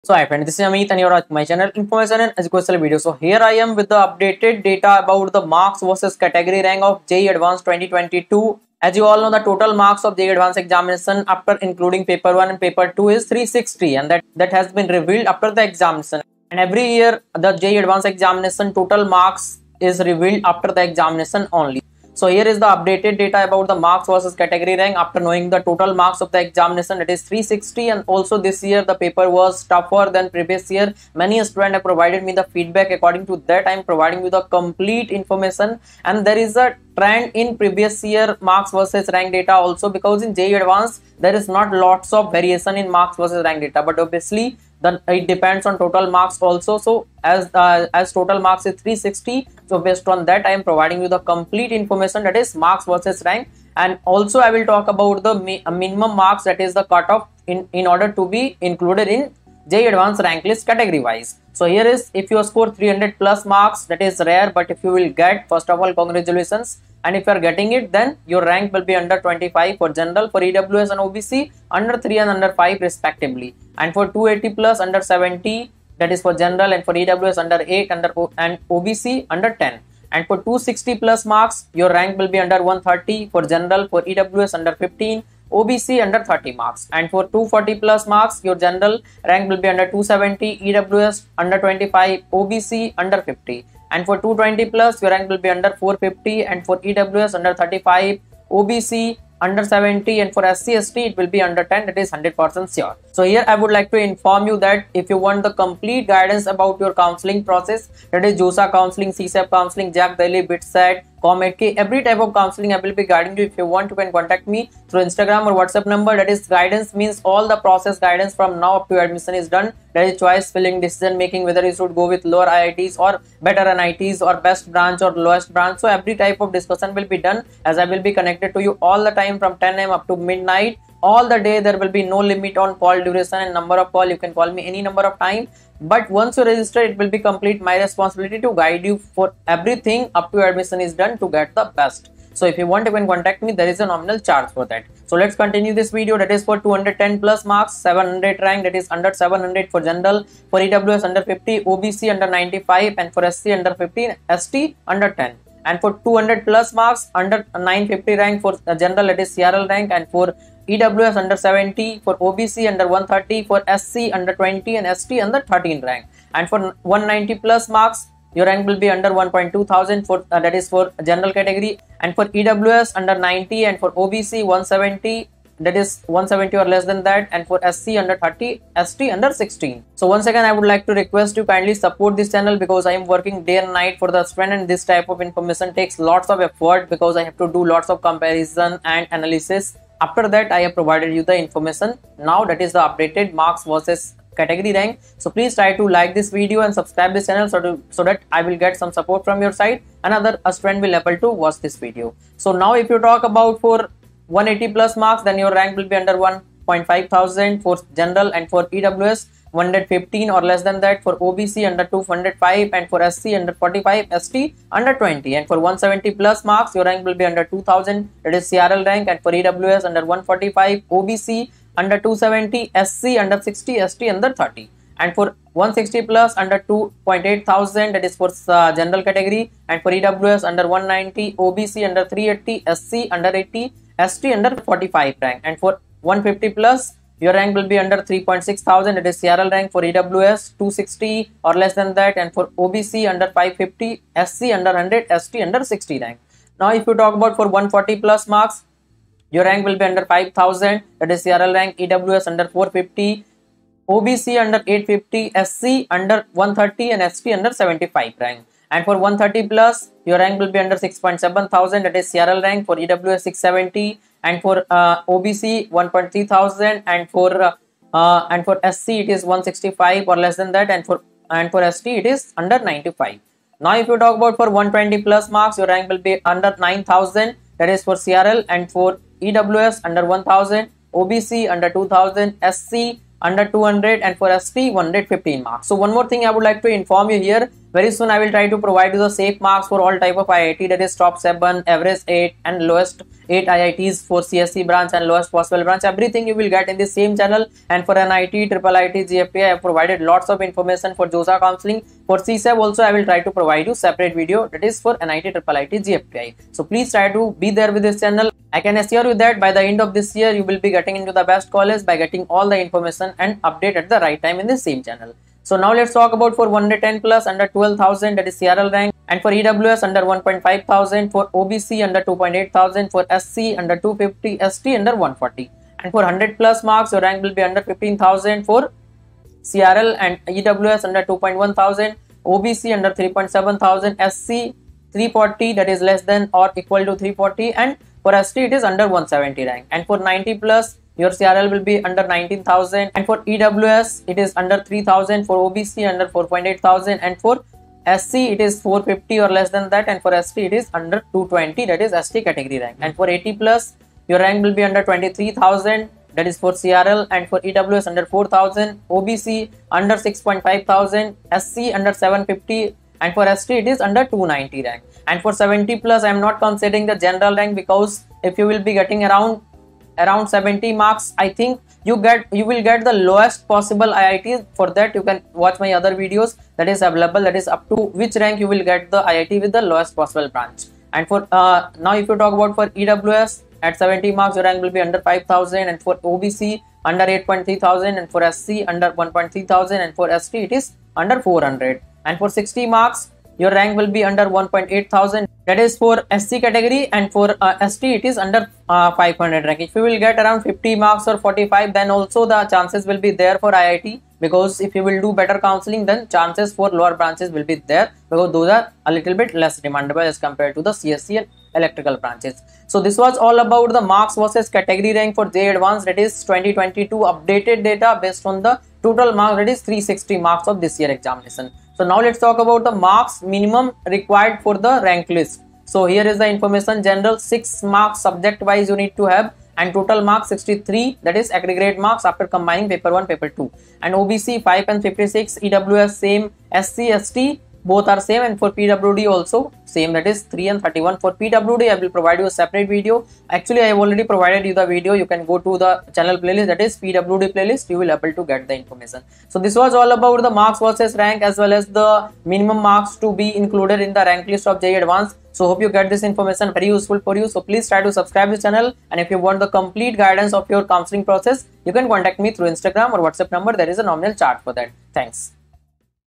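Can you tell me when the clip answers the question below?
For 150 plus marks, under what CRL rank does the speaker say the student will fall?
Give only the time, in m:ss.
3:58.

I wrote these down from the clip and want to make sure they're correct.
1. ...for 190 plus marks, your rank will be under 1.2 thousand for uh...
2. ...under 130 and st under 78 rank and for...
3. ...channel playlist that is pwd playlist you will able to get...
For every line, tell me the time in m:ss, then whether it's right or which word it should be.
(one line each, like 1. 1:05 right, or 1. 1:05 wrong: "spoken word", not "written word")
1. 2:46 right
2. 4:15 wrong: "75", not "78"
3. 7:25 right.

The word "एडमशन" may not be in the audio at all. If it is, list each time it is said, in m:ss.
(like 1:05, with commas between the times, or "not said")
1:59.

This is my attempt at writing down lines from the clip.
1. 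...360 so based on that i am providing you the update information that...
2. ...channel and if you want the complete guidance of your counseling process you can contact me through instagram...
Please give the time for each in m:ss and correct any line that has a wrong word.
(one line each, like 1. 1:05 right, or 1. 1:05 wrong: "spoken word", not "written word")
1. 0:48 wrong: "complete", not "update"
2. 7:38 right.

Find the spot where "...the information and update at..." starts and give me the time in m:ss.
5:12.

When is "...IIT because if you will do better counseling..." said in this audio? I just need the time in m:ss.
6:43.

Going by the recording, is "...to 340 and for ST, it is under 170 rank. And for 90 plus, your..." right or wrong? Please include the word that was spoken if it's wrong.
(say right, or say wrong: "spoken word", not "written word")
right.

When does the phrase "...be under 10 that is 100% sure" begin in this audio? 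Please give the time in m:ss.
1:41.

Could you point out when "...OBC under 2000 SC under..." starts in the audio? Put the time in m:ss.
4:40.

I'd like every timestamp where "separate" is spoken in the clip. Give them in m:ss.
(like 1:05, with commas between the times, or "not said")
5:03, 7:22.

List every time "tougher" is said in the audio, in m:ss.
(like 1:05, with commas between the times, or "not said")
0:29.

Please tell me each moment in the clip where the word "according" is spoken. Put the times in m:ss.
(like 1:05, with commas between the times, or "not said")
0:32.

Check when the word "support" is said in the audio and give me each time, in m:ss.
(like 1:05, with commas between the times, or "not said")
3:01, 3:18.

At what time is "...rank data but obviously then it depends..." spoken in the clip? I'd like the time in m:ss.
0:43.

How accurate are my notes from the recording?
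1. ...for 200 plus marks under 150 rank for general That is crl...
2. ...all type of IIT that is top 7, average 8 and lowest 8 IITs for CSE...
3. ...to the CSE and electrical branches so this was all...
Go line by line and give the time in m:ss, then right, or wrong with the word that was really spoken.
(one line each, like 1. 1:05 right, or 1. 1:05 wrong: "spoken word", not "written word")
1. 2:35 wrong: "950", not "150"
2. 4:49 right
3. 6:50 right.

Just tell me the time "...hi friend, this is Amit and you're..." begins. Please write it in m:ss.
0:00.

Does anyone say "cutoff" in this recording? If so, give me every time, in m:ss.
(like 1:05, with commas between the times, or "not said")
0:56.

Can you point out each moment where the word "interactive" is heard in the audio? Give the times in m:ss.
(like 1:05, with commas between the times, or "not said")
not said.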